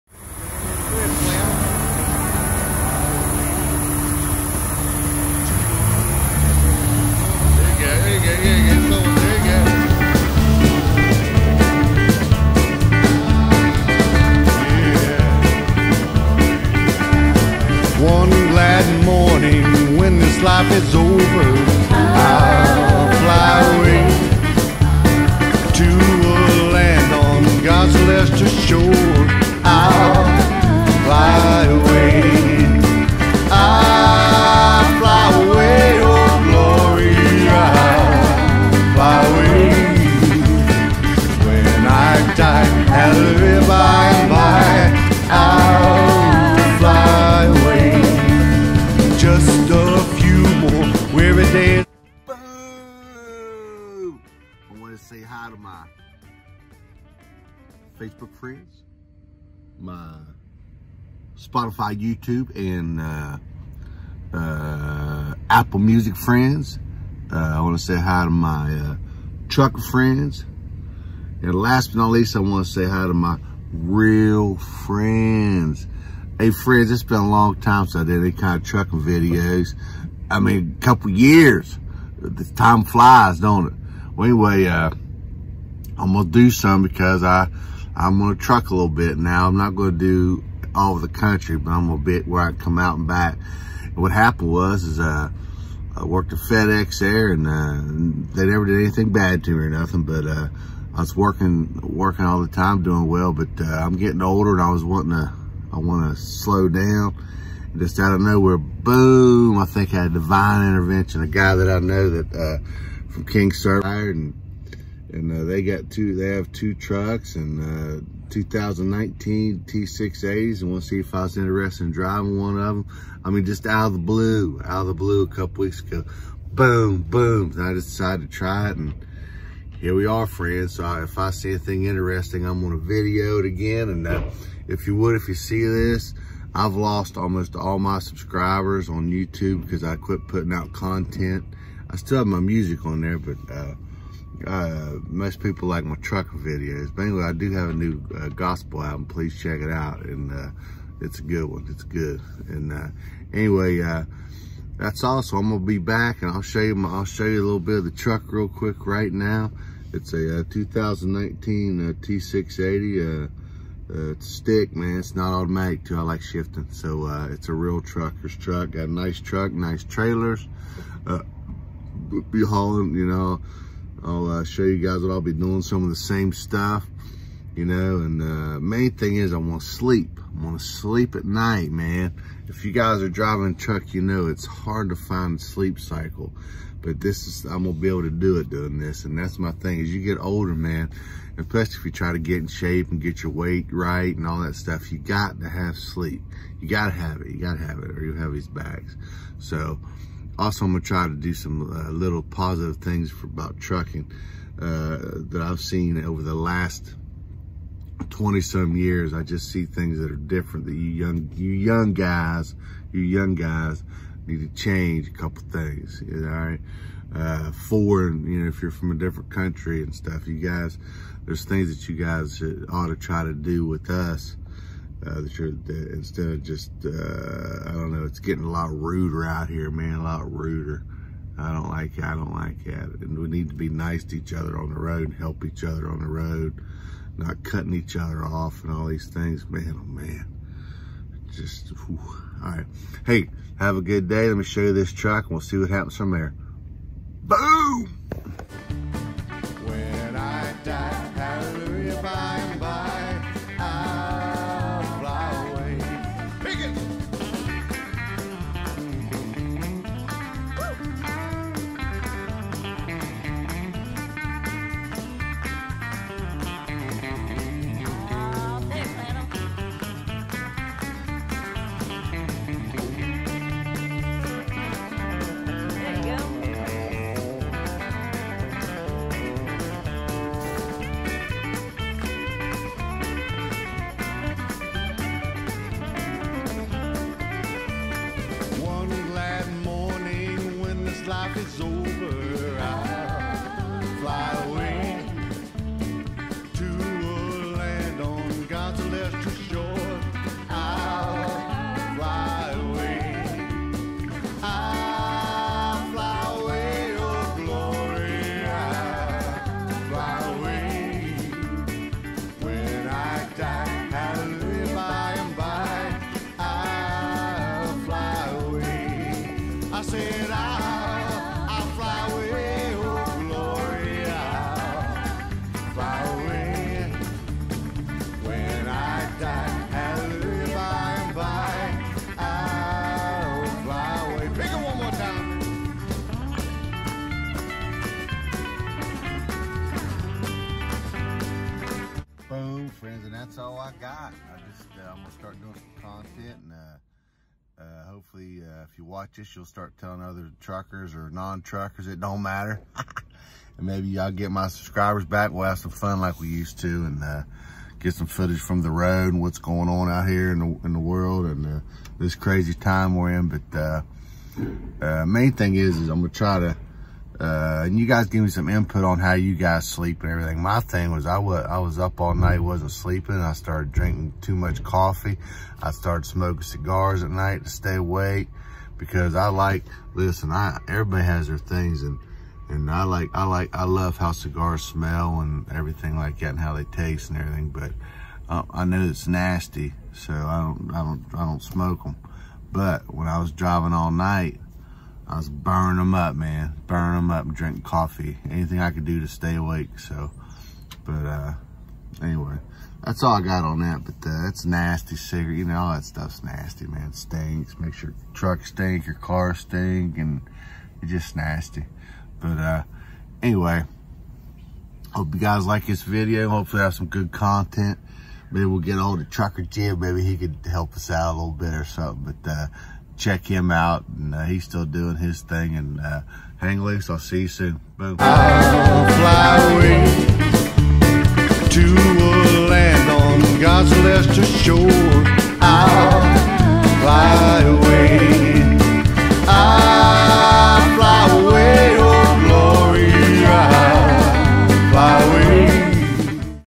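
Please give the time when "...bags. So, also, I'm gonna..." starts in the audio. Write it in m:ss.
3:18.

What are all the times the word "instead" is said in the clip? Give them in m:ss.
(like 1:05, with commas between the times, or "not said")
3:45.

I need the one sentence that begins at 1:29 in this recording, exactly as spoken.
I'm not going to do all of the country, but I'm a bit where I come out and back.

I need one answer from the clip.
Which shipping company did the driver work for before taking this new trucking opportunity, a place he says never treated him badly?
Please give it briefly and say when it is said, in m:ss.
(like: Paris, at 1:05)
FedEx, at 1:36.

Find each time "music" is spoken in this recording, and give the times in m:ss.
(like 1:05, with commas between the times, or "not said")
1:05, 2:22.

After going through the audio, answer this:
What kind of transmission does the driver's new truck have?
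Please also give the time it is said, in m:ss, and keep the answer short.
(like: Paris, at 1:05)
Stick, at 2:44.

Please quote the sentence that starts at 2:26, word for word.
But anyway, I do have a new uh, gospel album.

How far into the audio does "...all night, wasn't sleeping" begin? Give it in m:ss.
6:12.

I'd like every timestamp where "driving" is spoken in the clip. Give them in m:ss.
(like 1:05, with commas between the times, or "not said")
2:01, 3:03, 6:33.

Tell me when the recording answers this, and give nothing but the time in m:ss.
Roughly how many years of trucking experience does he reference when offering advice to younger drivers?
3:28.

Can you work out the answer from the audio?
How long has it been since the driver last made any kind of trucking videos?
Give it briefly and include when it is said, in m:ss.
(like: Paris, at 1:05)
A couple years, at 1:20.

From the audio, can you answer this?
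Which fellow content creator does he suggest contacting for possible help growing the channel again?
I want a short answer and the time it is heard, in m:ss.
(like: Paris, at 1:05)
Trucker Jim, at 6:59.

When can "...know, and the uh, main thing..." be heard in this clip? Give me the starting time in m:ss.
2:57.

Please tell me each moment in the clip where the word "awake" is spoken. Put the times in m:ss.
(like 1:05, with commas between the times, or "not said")
6:17, 6:39.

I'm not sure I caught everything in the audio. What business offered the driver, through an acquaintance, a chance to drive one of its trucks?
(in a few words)
King Service.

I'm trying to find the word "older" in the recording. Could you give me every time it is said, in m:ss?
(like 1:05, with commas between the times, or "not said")
1:44, 3:10.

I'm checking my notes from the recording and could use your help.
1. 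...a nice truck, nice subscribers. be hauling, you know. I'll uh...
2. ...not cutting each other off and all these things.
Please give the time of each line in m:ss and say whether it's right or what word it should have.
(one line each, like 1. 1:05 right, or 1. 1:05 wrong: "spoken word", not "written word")
1. 2:48 wrong: "trailers", not "subscribers"
2. 3:57 right.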